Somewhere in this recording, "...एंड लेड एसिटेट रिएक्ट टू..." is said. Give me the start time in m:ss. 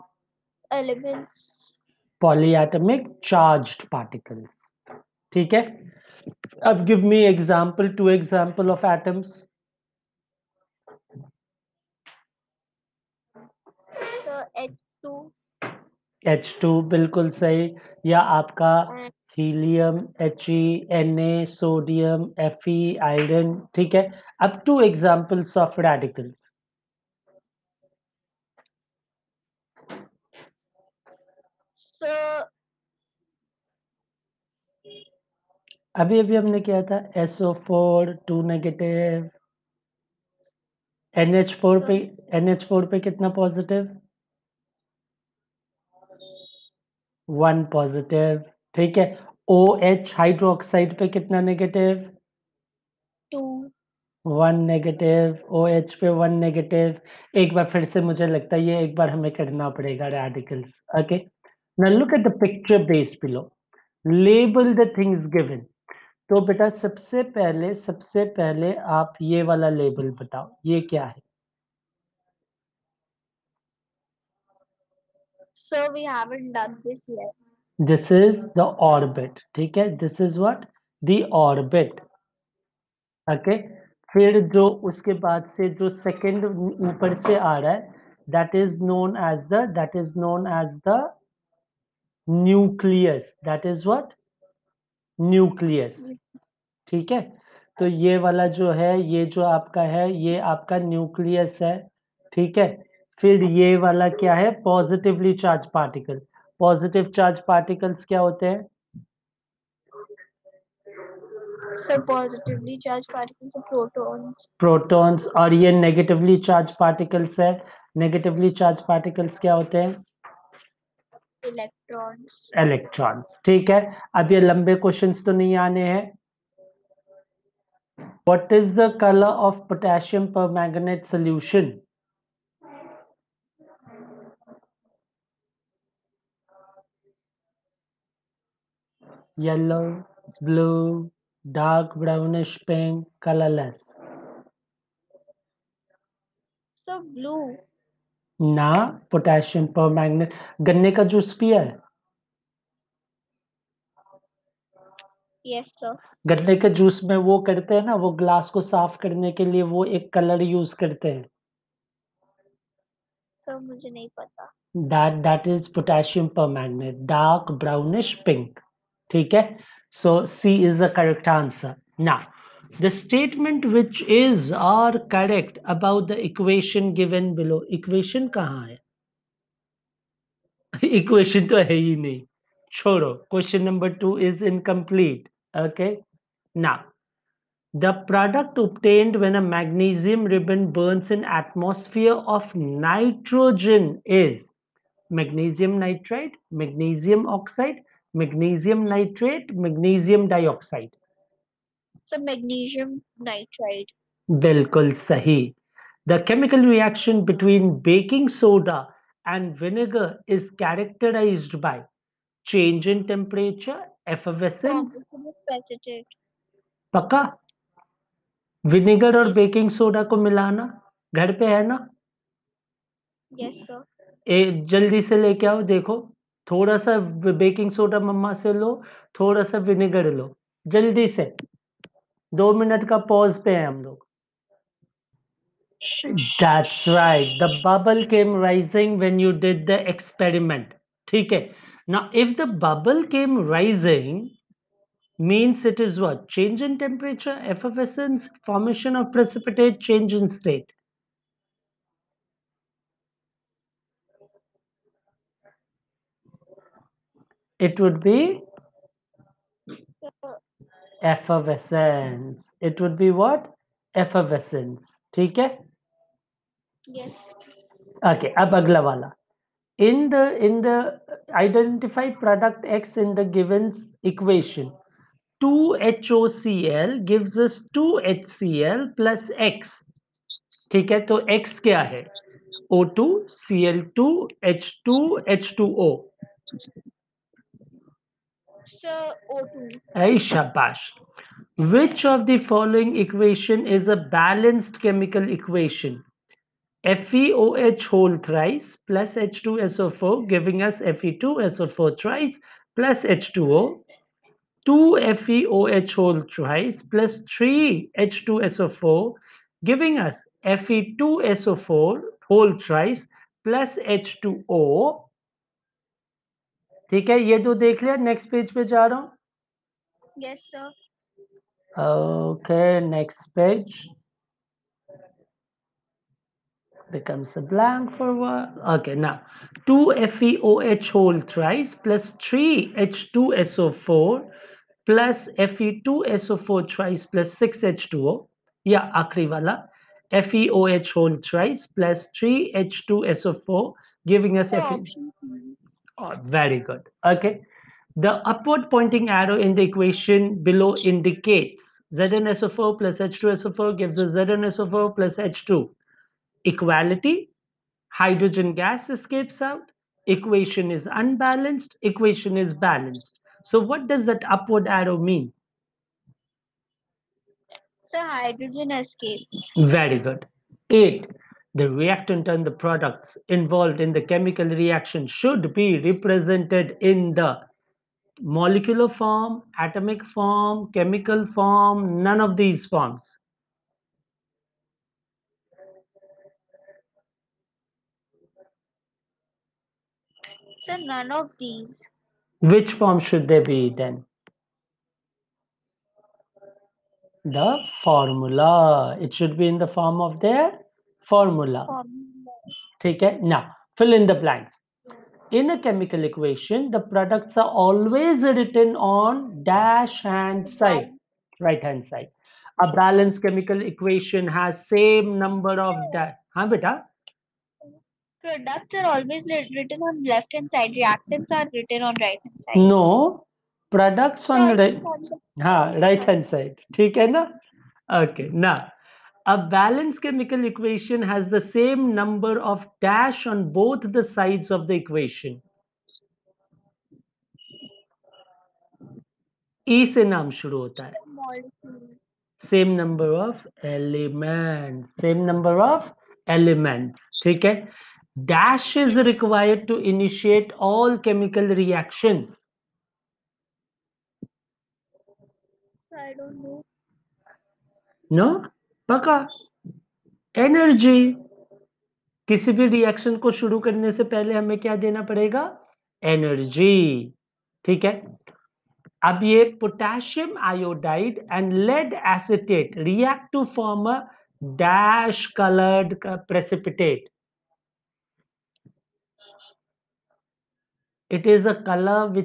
7:51.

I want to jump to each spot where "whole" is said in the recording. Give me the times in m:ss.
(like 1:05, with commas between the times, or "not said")
4:57, 5:05, 5:12, 5:30, 5:40.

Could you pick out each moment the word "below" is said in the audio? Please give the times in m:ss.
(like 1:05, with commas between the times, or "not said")
1:03, 2:57, 5:50.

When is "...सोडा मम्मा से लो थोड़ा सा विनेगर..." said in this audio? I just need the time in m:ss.
3:47.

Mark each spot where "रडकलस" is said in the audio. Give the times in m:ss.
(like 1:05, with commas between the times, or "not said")
0:25, 1:00.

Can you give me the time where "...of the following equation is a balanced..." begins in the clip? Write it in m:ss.
4:52.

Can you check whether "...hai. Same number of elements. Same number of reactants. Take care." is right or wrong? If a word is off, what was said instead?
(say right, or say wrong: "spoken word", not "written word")
wrong: "elements", not "reactants".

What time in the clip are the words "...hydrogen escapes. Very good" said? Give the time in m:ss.
6:07.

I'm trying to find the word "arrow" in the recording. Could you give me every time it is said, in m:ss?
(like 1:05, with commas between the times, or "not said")
5:49, 6:04.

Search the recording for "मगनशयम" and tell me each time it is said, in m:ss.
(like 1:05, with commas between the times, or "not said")
3:22.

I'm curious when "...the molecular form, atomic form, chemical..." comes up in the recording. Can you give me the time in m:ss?
6:17.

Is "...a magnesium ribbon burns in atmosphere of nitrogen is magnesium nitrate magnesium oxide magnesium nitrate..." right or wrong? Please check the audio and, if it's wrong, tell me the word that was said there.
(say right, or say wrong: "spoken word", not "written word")
right.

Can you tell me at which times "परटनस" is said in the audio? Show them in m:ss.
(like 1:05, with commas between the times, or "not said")
1:54.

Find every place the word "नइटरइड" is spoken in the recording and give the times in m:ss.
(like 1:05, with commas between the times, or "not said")
3:23.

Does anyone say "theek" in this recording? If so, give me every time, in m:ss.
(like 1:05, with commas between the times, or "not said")
4:25, 7:06.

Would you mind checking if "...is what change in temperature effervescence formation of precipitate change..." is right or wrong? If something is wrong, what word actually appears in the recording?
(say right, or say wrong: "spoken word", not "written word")
right.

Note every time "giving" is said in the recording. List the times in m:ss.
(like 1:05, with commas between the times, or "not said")
5:00, 5:09, 5:44.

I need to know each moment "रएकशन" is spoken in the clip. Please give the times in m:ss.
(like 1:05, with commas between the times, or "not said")
3:26, 7:42.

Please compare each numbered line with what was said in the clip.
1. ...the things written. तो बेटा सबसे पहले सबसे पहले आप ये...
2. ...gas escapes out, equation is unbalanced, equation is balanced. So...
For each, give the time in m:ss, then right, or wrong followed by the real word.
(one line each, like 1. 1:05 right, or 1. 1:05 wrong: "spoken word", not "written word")
1. 1:04 wrong: "given", not "written"
2. 5:58 right.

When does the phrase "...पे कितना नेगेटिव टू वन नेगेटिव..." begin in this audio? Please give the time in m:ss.
0:50.